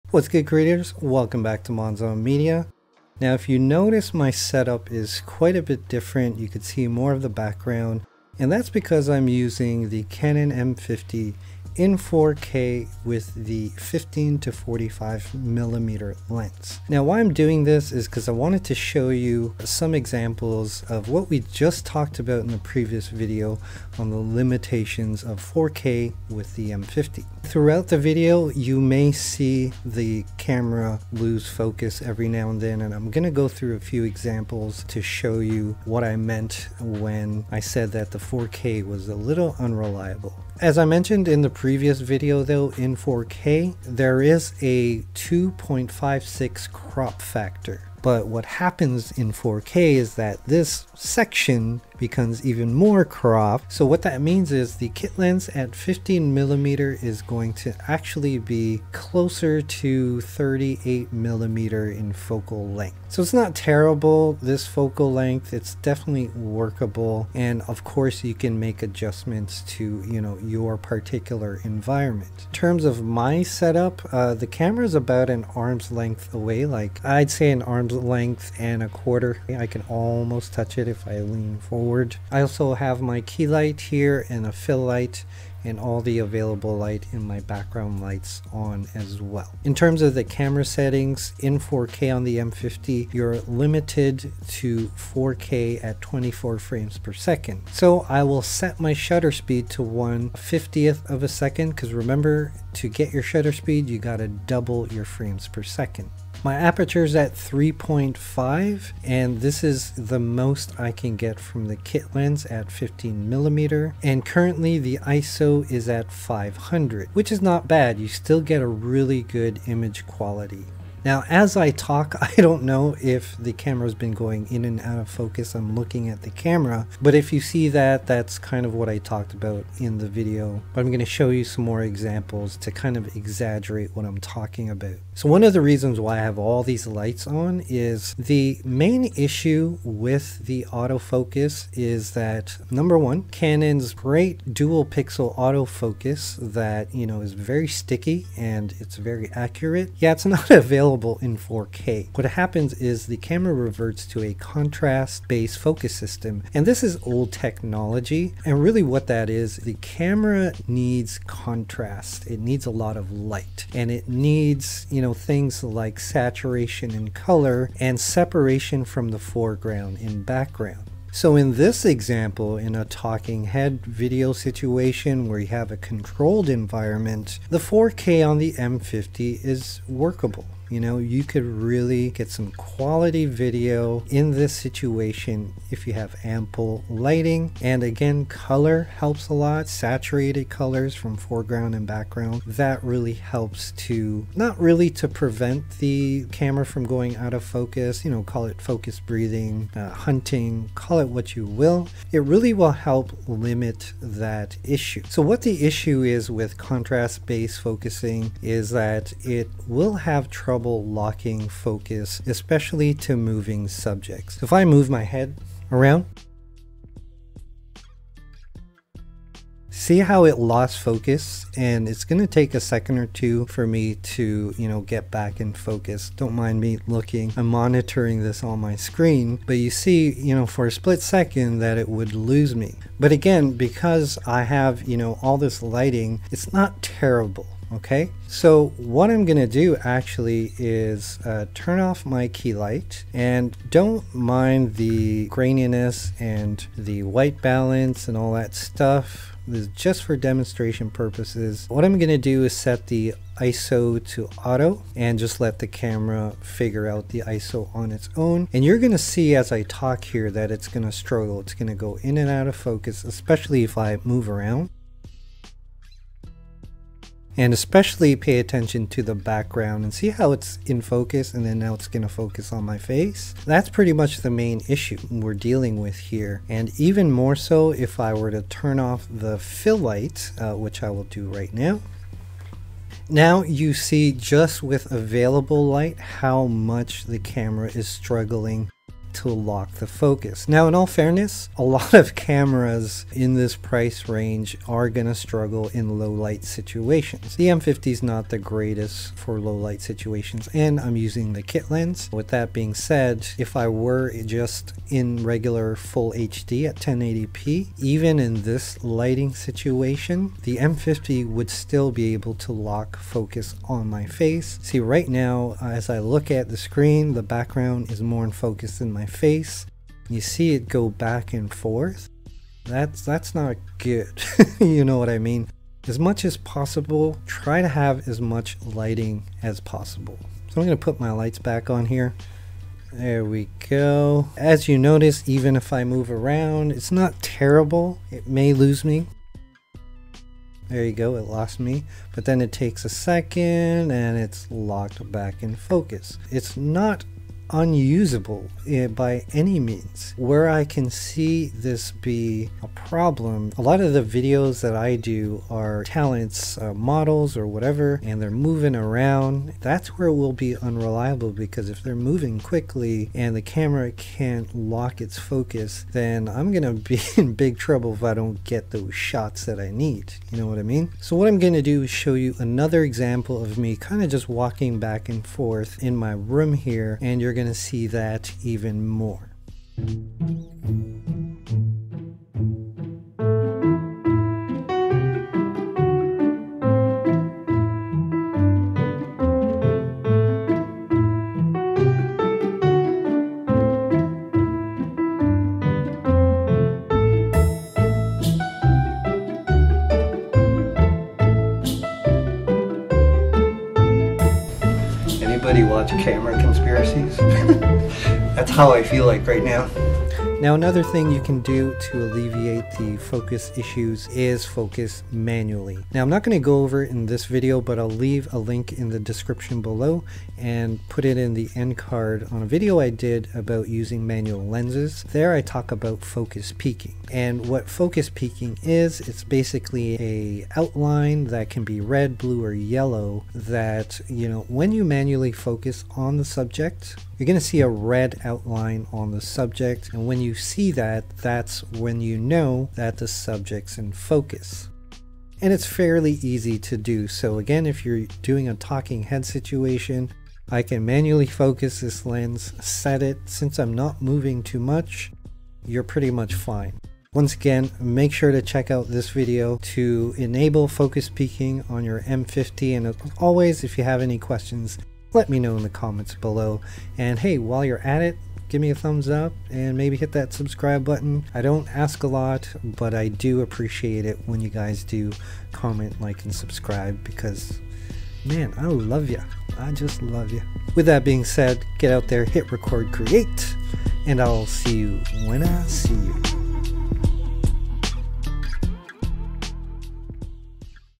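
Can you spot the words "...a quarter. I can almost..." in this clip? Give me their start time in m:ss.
1:18.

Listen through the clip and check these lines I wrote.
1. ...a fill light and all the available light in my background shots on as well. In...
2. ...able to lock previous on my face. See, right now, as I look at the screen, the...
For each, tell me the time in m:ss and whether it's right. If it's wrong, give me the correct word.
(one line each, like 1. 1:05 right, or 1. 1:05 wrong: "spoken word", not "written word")
1. 1:24 wrong: "lights", not "shots"
2. 5:12 wrong: "focus", not "previous".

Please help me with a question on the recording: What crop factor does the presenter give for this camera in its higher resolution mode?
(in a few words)
2.56.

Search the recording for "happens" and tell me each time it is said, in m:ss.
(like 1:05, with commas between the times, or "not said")
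0:48, 2:32.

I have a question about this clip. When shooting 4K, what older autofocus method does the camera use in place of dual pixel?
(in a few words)
contrast-based focus.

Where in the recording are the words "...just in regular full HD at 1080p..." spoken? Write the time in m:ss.
5:04.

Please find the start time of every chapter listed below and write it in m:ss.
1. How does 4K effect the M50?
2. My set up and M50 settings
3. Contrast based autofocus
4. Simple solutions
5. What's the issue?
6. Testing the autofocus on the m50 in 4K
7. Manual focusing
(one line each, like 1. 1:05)
1. 0:42
2. 1:12
3. 2:15
4. 2:56
5. 3:25
6. 3:58
7. 6:50.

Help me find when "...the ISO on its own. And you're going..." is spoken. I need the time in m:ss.
4:17.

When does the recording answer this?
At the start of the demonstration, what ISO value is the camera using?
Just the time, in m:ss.
1:56.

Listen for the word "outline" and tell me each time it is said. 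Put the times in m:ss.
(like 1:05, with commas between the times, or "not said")
7:10, 7:18.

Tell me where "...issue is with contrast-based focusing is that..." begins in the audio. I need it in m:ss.
3:25.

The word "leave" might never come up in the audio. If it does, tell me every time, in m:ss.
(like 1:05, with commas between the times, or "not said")
6:57.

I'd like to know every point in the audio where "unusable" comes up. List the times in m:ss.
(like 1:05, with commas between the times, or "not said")
5:47.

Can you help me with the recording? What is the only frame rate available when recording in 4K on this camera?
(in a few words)
24 frames per second.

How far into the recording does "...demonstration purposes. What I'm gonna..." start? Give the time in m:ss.
4:10.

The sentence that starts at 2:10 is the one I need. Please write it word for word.
But I'm going to show you some more examples to kind of exaggerate what I'm talking about.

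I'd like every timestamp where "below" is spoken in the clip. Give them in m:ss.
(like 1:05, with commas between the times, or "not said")
6:59, 7:46.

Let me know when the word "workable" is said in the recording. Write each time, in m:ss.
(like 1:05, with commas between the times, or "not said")
1:06, 2:59.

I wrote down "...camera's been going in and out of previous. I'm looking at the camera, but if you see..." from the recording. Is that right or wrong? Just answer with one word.
wrong.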